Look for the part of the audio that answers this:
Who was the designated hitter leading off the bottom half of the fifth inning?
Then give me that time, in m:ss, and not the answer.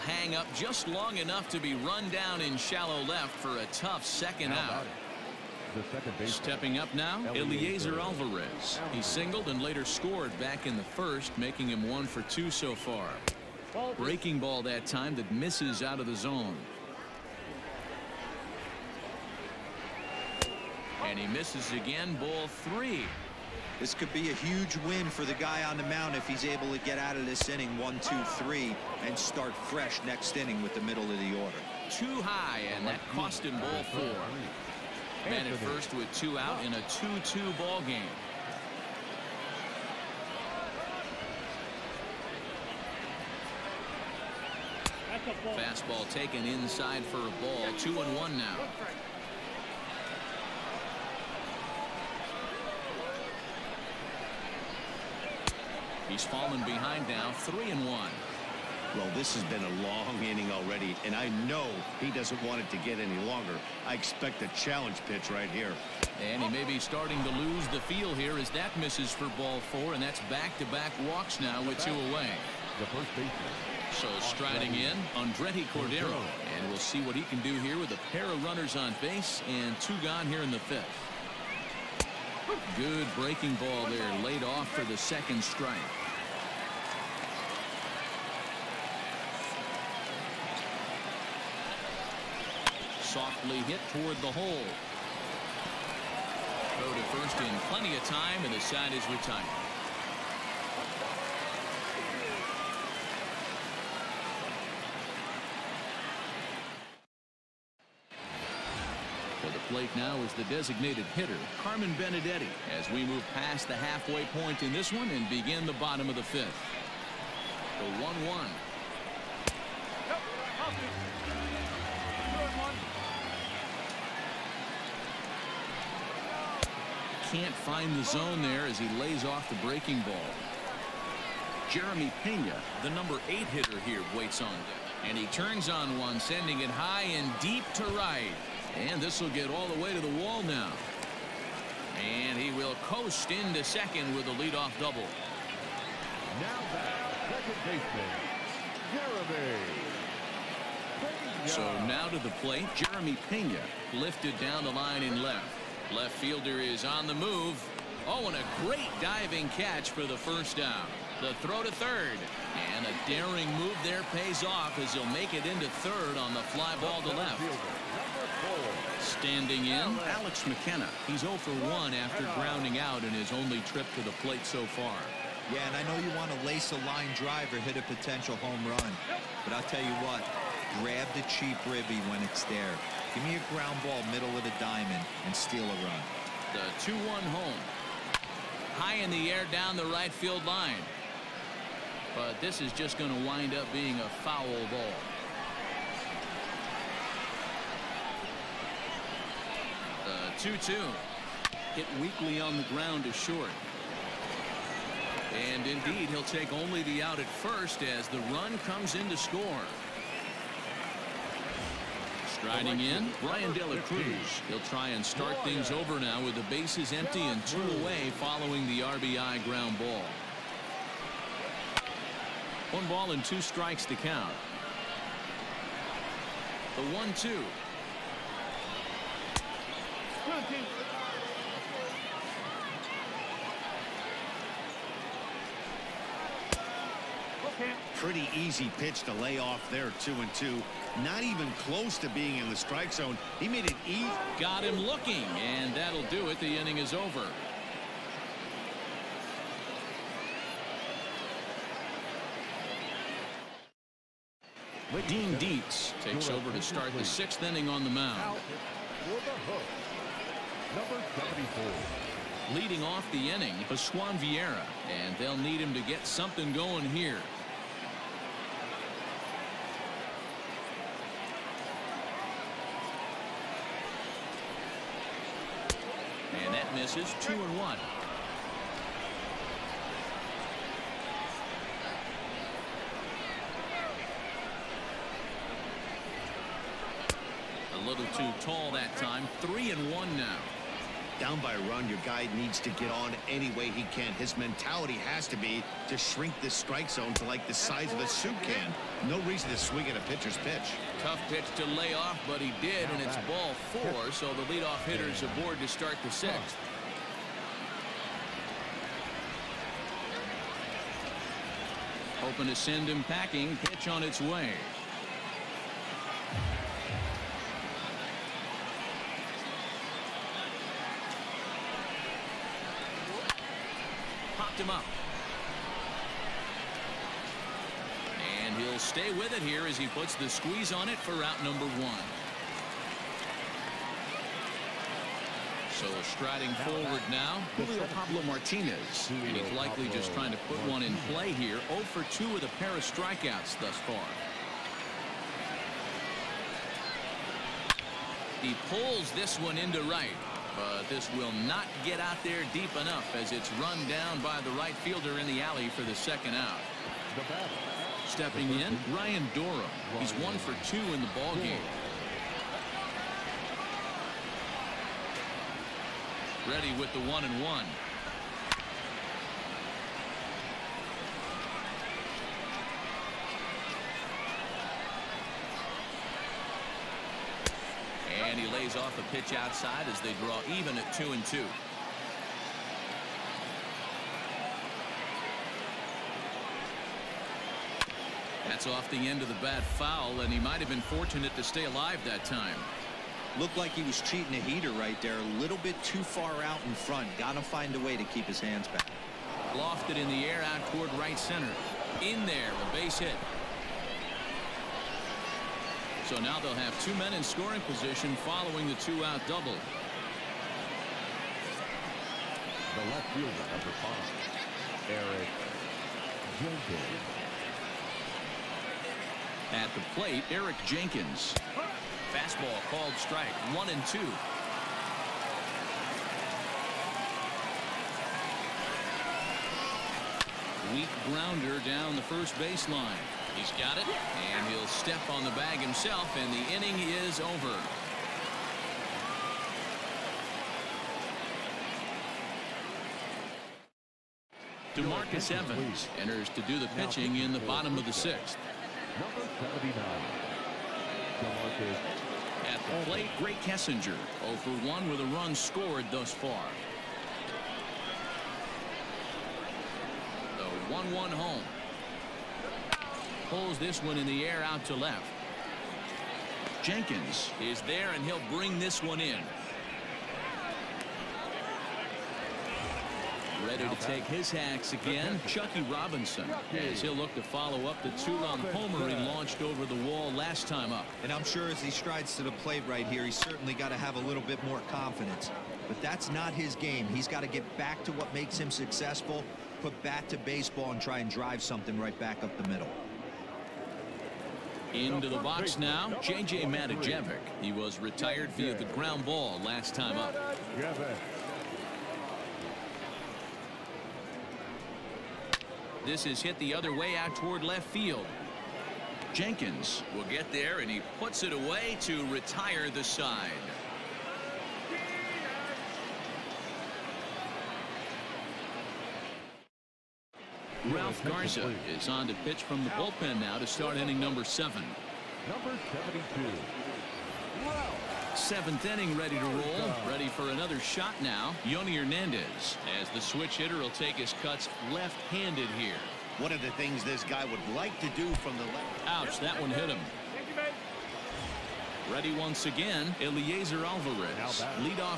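1:51.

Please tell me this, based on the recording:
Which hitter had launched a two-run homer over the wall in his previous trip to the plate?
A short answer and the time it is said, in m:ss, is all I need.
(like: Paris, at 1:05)
Chuckie Robinson, at 7:55.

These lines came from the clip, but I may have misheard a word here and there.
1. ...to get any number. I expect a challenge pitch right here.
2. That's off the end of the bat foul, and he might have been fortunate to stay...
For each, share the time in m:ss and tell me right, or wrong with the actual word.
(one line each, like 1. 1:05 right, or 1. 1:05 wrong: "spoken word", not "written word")
1. 1:02 wrong: "longer", not "number"
2. 6:28 right.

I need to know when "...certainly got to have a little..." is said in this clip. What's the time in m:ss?
8:03.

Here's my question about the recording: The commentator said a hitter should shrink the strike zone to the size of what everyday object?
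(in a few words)
a soup can.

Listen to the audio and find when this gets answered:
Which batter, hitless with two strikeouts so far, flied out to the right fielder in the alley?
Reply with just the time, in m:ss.
5:37.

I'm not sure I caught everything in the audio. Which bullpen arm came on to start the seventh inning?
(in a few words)
Ralph Garza.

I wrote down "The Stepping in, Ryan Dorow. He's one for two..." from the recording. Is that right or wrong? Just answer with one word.
right.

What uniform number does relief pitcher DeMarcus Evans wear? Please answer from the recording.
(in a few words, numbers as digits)
79.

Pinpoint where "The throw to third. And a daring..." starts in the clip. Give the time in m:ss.
2:41.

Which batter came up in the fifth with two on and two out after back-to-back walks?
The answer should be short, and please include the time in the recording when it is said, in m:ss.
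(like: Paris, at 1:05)
Andretti Cordero, at 1:15.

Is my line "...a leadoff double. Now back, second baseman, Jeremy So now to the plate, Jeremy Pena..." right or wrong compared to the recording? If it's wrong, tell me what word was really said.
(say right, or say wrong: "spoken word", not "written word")
right.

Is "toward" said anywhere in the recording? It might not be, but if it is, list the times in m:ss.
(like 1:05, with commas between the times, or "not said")
1:33, 6:40, 8:27.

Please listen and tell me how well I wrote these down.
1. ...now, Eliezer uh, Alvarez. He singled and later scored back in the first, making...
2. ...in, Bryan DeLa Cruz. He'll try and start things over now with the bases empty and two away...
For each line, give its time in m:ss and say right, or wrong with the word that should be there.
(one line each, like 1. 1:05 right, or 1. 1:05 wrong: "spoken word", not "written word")
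1. 0:06 right
2. 3:32 right.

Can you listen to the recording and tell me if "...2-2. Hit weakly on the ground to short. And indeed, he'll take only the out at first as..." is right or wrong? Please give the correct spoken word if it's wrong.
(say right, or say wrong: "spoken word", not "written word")
right.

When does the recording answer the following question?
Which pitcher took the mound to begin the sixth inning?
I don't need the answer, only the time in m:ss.
4:15.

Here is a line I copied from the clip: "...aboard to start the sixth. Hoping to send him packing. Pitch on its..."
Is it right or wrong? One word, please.
right.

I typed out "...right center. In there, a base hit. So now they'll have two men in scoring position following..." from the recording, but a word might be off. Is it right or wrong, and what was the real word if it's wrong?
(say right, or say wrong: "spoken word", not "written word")
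right.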